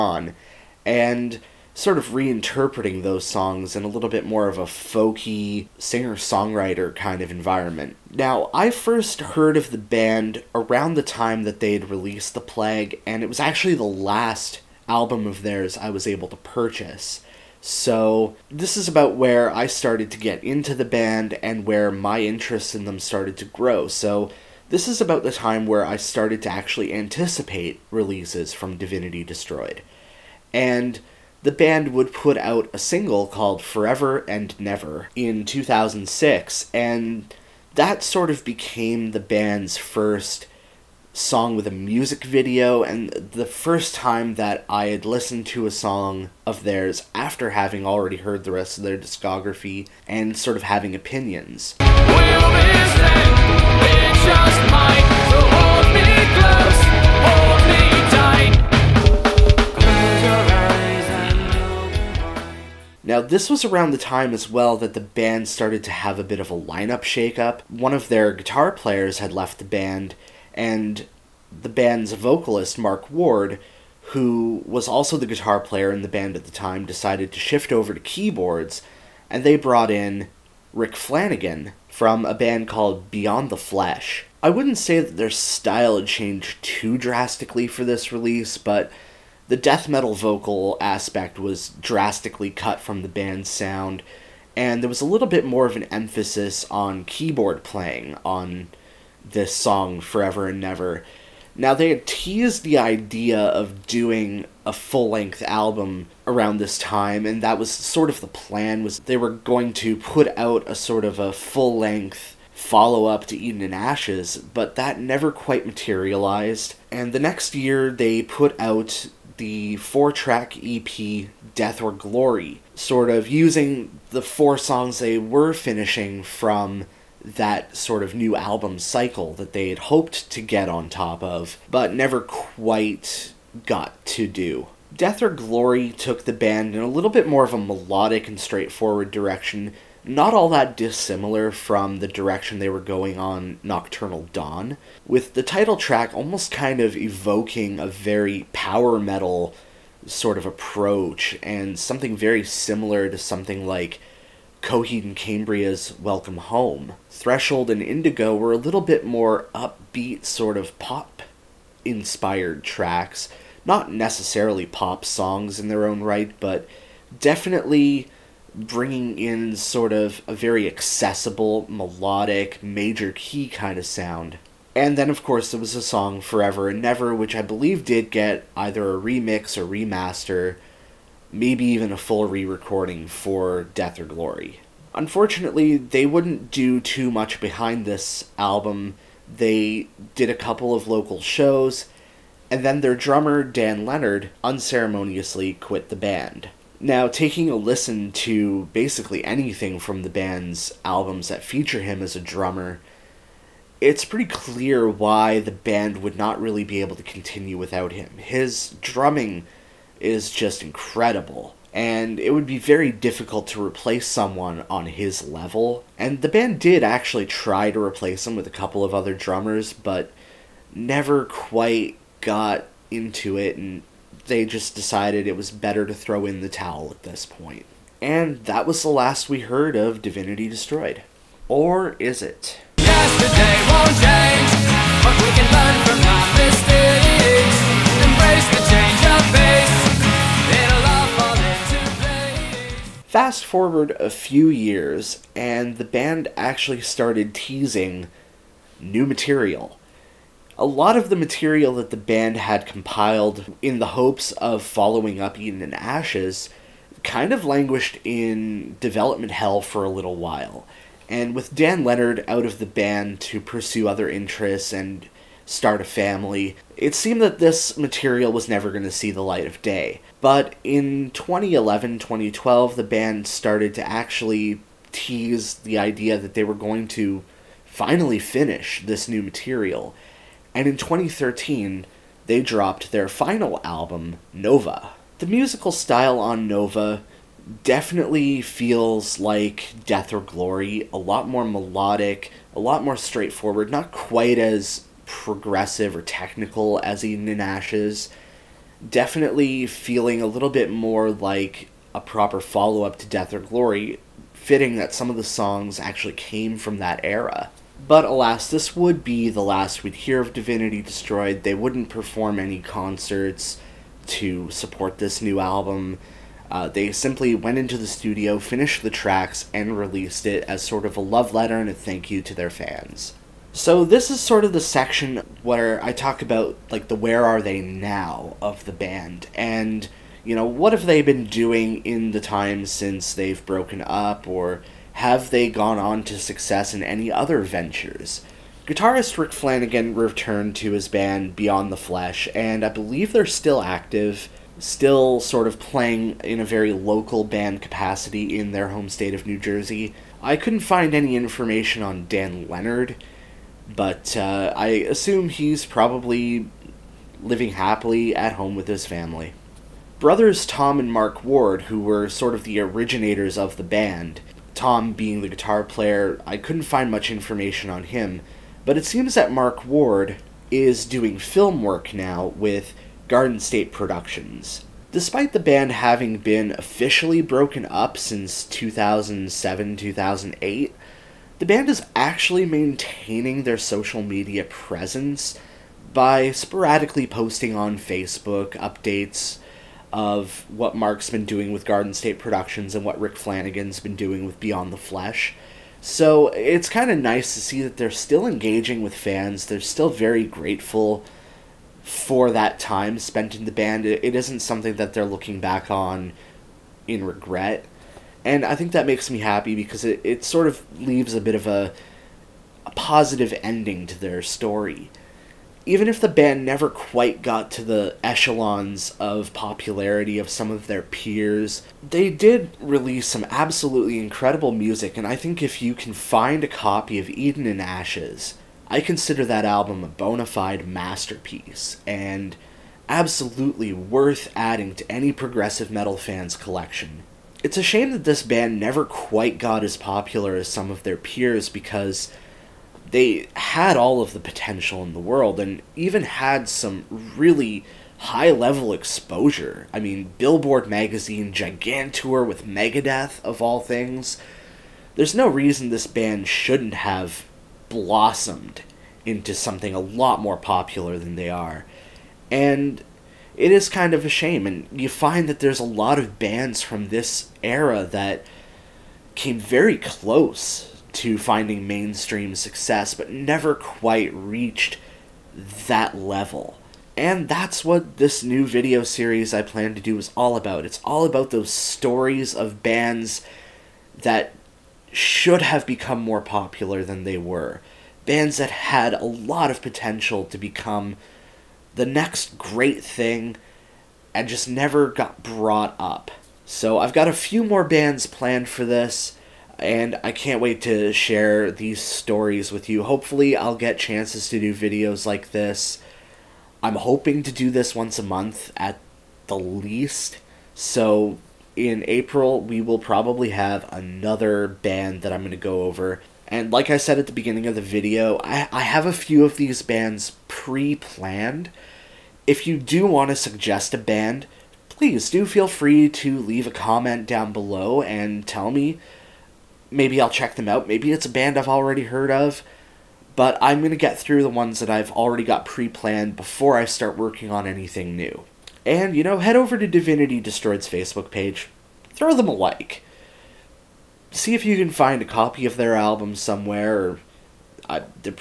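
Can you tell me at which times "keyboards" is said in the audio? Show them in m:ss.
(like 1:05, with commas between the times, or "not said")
1:17, 1:37.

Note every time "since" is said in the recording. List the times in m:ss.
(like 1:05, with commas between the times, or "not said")
5:32, 6:17.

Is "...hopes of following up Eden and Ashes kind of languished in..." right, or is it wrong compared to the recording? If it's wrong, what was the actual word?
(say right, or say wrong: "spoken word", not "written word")
right.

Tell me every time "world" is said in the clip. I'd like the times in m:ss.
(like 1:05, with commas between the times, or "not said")
7:24.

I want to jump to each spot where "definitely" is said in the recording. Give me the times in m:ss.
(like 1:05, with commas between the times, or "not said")
2:47, 4:47, 4:58.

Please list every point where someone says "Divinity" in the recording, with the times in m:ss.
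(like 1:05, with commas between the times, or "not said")
0:28, 3:50, 5:10, 8:59.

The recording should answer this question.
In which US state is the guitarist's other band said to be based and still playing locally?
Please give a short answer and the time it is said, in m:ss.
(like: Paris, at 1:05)
New Jersey, at 5:49.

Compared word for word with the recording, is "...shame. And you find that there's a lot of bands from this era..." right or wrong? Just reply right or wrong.
right.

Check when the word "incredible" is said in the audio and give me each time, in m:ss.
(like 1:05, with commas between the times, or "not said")
3:30, 7:03.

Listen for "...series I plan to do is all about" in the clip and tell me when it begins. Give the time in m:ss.
7:58.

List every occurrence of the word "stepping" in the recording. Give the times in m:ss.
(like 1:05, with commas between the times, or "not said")
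not said.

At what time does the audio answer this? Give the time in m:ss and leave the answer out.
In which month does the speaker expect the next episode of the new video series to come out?
8:31.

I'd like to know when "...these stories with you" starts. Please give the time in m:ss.
8:21.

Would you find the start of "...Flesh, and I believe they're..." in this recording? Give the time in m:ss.
5:41.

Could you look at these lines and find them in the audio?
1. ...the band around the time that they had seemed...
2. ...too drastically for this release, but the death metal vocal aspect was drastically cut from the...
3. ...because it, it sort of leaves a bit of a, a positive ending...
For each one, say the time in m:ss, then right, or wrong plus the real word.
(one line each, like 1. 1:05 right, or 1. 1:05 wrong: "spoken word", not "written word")
1. 0:09 wrong: "released", not "seemed"
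2. 1:26 right
3. 6:49 right.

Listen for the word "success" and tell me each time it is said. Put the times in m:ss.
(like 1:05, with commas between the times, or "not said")
5:36, 7:52.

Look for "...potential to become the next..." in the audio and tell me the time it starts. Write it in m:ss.
8:09.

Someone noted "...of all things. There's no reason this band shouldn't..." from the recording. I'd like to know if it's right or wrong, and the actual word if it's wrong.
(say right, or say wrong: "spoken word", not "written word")
right.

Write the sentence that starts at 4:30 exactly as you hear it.
But in 2011 2012, the band started to actually tease the idea that they were going to finally finish this new material.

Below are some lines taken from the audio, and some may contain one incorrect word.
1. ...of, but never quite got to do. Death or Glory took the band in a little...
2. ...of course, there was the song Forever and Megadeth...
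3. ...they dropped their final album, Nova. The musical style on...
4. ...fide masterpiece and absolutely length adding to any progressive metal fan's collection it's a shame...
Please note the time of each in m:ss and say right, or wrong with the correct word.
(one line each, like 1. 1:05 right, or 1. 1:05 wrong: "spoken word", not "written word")
1. 2:11 right
2. 2:55 wrong: "Never", not "Megadeth"
3. 4:42 right
4. 7:10 wrong: "worth", not "length".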